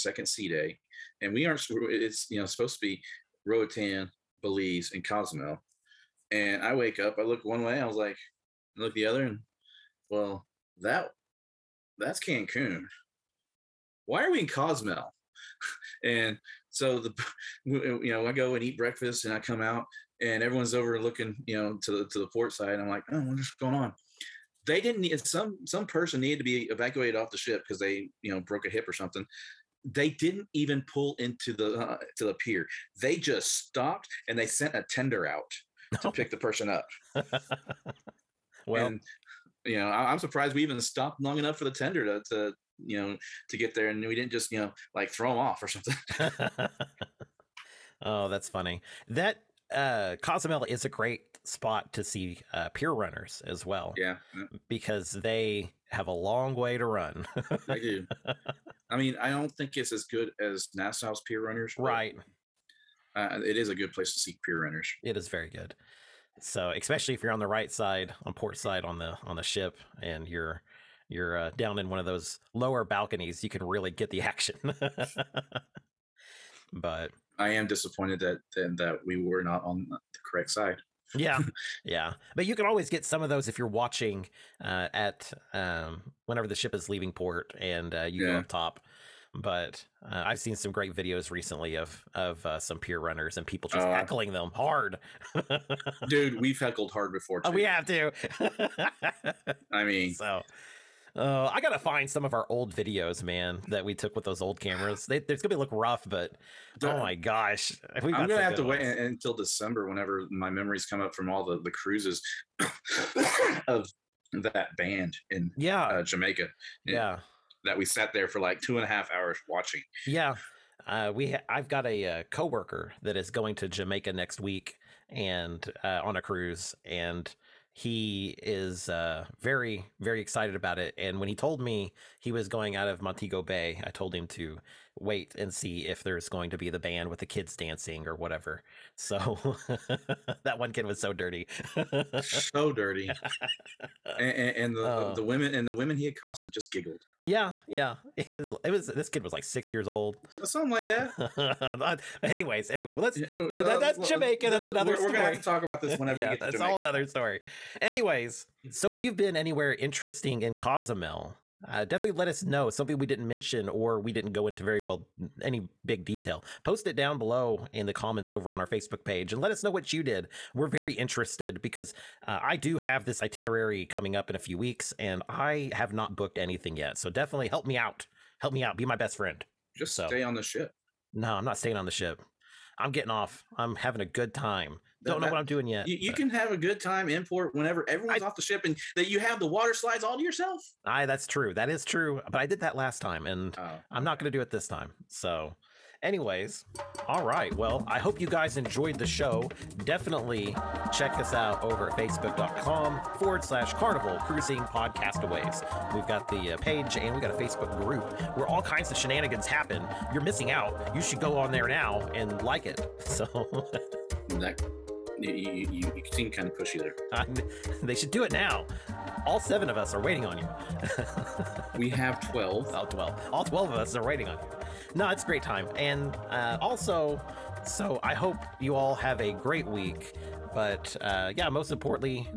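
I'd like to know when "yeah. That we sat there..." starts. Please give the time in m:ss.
1:56.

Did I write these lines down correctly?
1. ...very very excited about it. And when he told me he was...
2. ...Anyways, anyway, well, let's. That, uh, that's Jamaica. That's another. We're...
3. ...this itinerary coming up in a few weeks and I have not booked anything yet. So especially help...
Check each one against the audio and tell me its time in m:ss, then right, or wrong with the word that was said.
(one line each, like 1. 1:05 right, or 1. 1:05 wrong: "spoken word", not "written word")
1. 2:09 right
2. 2:32 right
3. 2:53 wrong: "definitely", not "especially".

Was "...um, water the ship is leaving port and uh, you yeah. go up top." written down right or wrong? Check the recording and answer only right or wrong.
wrong.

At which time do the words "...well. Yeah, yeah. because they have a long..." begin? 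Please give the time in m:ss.
0:53.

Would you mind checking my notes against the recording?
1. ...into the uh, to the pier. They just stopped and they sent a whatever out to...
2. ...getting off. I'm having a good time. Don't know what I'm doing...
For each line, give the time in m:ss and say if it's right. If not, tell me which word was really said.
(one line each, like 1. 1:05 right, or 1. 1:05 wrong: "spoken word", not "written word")
1. 0:31 wrong: "tender", not "whatever"
2. 3:02 right.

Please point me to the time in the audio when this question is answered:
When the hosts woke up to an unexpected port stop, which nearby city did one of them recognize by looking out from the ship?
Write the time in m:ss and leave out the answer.
0:12.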